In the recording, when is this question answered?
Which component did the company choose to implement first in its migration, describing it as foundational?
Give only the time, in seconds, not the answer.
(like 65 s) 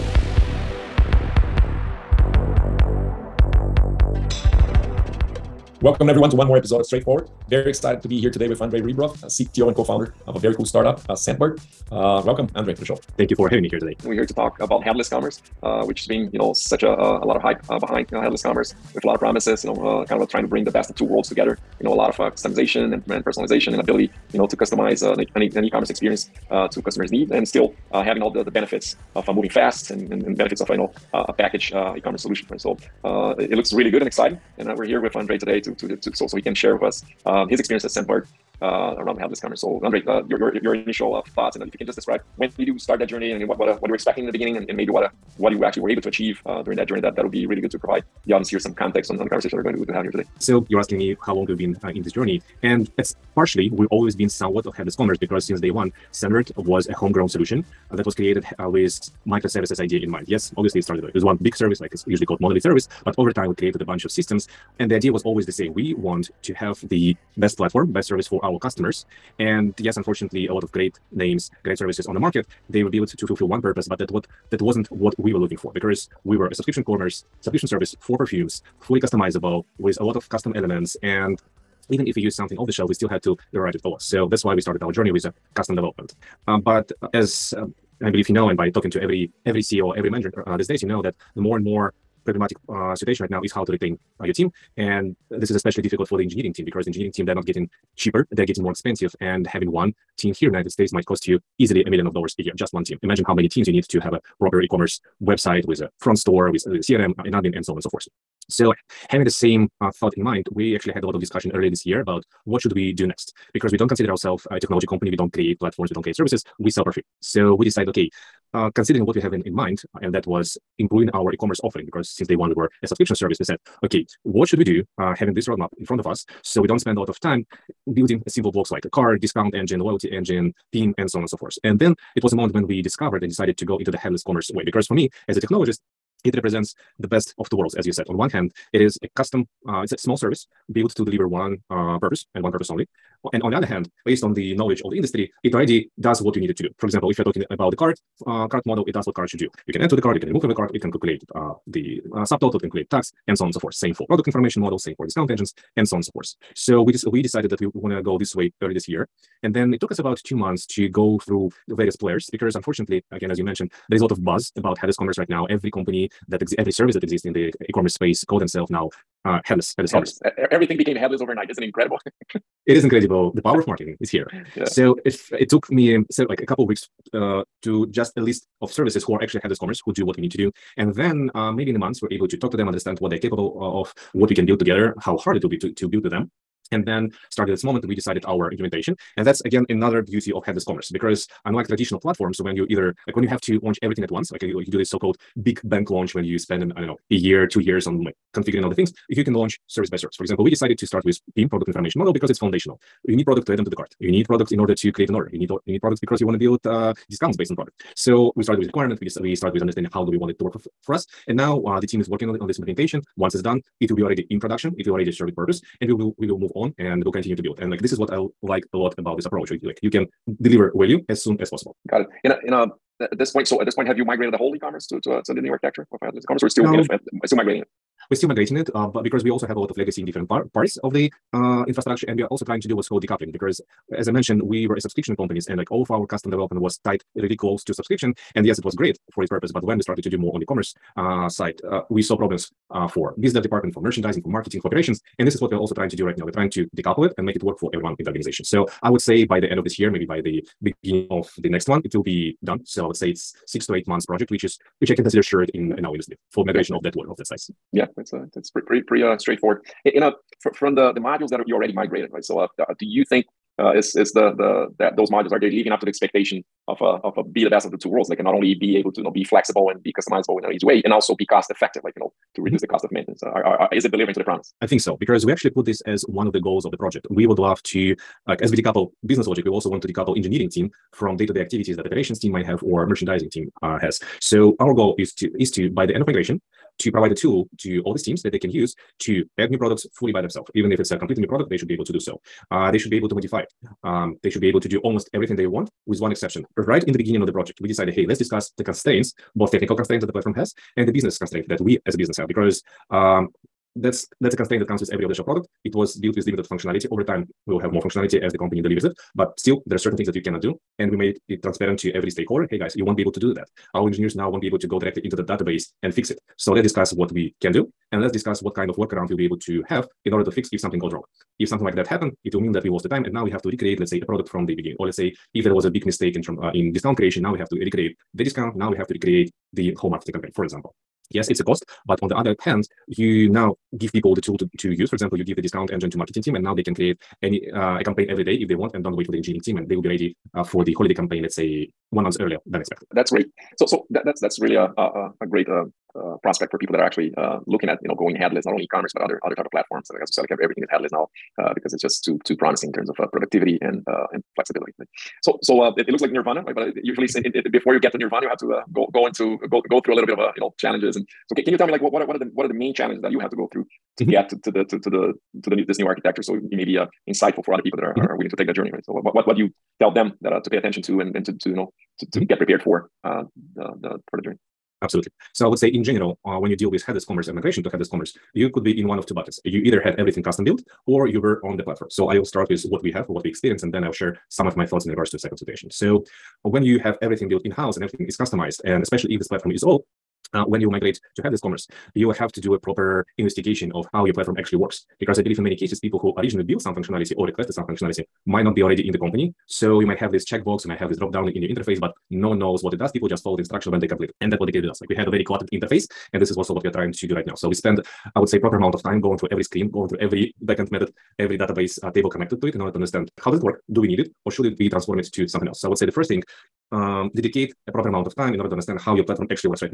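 201 s.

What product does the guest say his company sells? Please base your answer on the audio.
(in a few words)
perfume.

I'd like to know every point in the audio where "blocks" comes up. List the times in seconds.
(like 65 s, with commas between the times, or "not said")
128 s.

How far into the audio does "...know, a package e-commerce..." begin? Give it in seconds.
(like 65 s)
30 s.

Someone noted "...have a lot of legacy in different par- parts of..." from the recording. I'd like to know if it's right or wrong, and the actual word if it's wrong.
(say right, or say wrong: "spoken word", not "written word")
right.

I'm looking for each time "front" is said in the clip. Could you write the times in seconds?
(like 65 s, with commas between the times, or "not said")
105 s, 125 s.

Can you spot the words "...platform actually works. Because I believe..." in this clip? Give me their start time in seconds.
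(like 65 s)
394 s.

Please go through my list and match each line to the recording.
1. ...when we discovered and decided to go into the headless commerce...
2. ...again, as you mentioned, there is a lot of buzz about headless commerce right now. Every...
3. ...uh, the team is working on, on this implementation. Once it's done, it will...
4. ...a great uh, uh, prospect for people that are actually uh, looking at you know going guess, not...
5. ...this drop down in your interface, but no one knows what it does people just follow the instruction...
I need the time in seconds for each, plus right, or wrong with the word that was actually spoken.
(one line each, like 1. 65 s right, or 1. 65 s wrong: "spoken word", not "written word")
1. 132 s right
2. 163 s right
3. 211 s right
4. 345 s wrong: "headless", not "guess"
5. 400 s right.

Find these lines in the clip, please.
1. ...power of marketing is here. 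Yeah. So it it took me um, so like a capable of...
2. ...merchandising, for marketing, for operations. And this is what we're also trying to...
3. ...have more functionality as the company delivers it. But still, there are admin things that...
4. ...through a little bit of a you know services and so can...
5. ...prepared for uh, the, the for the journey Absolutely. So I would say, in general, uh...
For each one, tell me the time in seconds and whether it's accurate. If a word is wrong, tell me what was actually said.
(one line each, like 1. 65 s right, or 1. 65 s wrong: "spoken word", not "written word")
1. 173 s wrong: "couple", not "capable"
2. 243 s right
3. 307 s wrong: "certain", not "admin"
4. 359 s wrong: "challenges", not "services"
5. 372 s right.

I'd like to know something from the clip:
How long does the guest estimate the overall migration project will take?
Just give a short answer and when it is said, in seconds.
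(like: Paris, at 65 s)
6 to 8 months, at 253 s.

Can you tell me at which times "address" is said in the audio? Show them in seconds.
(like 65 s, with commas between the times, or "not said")
not said.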